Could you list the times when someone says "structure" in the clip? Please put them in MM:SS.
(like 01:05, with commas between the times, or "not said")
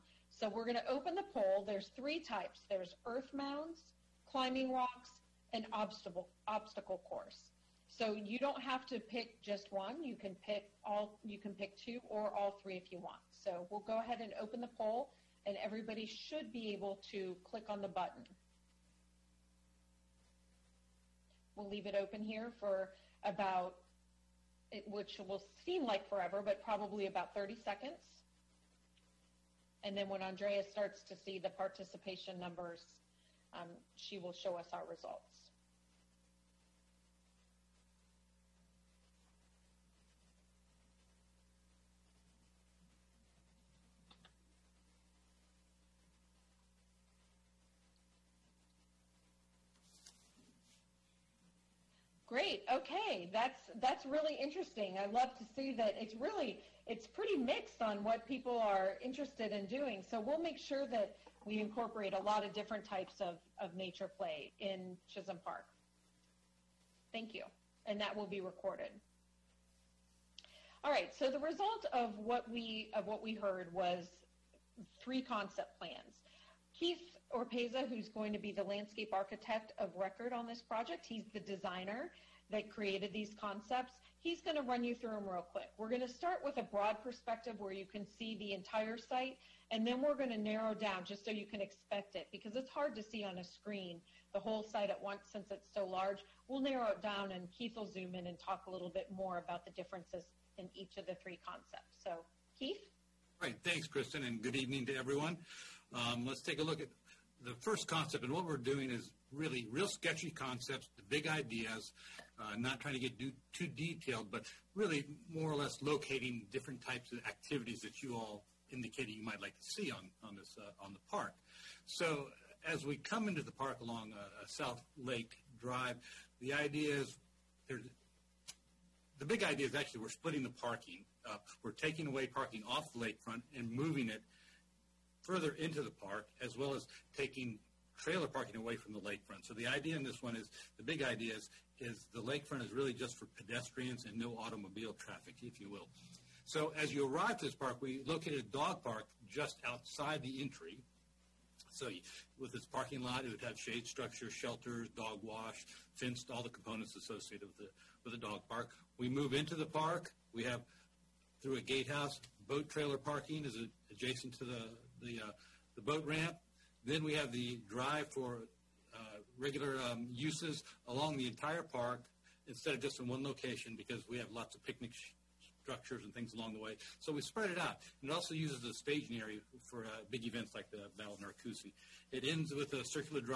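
02:33, 02:55.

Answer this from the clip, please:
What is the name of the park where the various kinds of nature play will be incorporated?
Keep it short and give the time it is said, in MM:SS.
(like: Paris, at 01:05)
Chisholm Park, at 01:05.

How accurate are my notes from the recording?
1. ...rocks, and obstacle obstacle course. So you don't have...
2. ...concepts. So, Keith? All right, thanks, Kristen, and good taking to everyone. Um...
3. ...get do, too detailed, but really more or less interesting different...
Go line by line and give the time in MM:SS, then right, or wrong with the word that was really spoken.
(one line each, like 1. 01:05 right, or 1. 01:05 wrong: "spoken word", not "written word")
1. 00:04 right
2. 01:41 wrong: "evening", not "taking"
3. 01:53 wrong: "locating", not "interesting".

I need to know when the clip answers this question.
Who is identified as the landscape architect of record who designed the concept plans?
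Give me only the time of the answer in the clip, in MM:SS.
01:16.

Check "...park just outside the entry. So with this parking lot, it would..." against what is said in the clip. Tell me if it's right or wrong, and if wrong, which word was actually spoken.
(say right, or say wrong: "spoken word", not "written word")
right.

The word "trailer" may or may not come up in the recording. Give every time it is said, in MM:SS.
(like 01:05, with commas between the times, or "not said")
02:17, 02:42.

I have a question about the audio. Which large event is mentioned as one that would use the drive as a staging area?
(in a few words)
Battle of Narcoossee.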